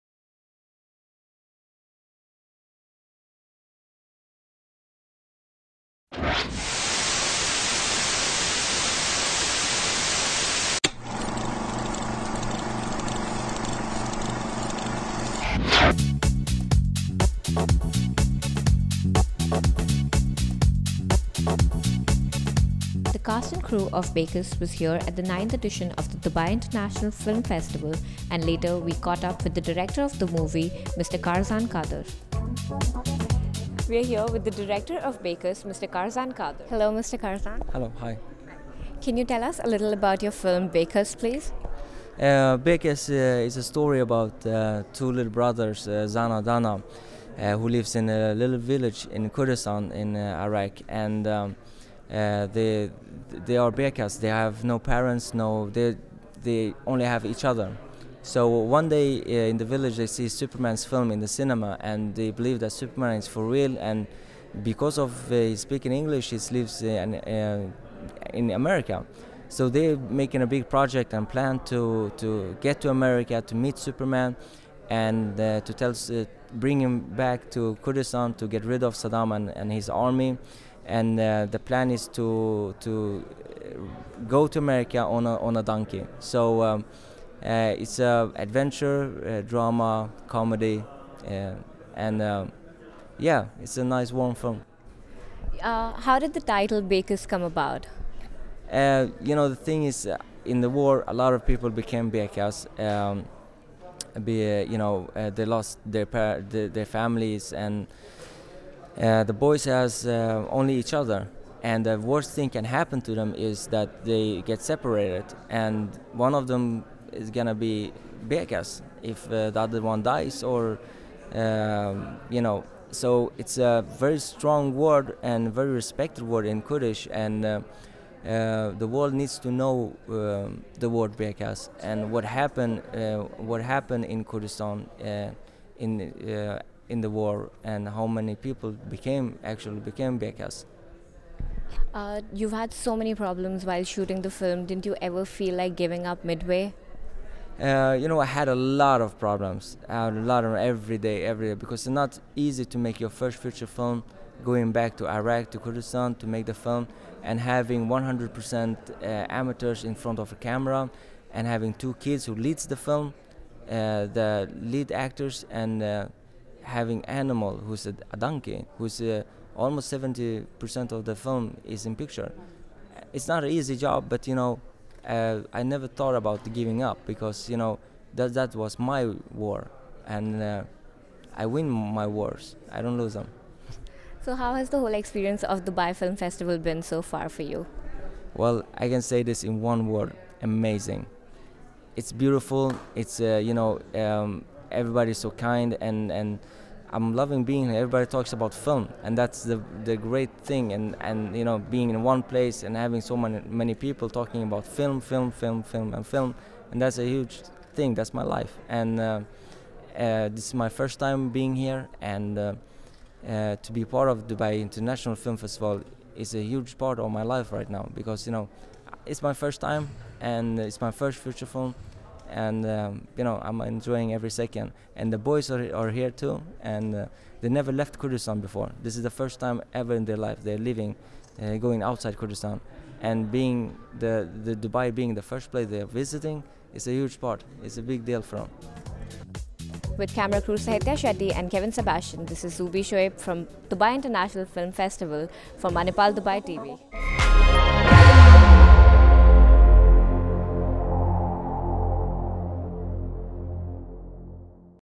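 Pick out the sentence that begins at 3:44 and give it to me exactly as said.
And the boys are, are here too, and uh, they never left Kurdistan before.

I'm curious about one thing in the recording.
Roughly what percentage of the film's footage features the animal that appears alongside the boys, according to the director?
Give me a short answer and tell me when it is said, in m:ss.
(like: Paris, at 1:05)
70%, at 2:49.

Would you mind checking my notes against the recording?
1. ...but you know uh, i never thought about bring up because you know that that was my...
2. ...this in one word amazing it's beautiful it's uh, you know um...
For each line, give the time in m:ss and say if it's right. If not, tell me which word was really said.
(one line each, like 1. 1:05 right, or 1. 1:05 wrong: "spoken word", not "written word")
1. 2:54 wrong: "giving", not "bring"
2. 3:09 right.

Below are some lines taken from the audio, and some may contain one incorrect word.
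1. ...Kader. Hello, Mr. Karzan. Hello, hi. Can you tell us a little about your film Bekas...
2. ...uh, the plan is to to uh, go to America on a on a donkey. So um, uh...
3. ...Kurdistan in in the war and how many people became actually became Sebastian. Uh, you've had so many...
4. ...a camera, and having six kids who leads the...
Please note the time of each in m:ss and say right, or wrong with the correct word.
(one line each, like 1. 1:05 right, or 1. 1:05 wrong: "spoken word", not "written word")
1. 0:36 right
2. 1:21 right
3. 2:14 wrong: "Bekas", not "Sebastian"
4. 2:40 wrong: "two", not "six".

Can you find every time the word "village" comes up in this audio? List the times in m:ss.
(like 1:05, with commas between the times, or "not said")
0:48, 0:59.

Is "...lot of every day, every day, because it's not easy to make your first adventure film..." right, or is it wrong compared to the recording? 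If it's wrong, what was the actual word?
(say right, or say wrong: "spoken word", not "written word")
wrong: "feature", not "adventure".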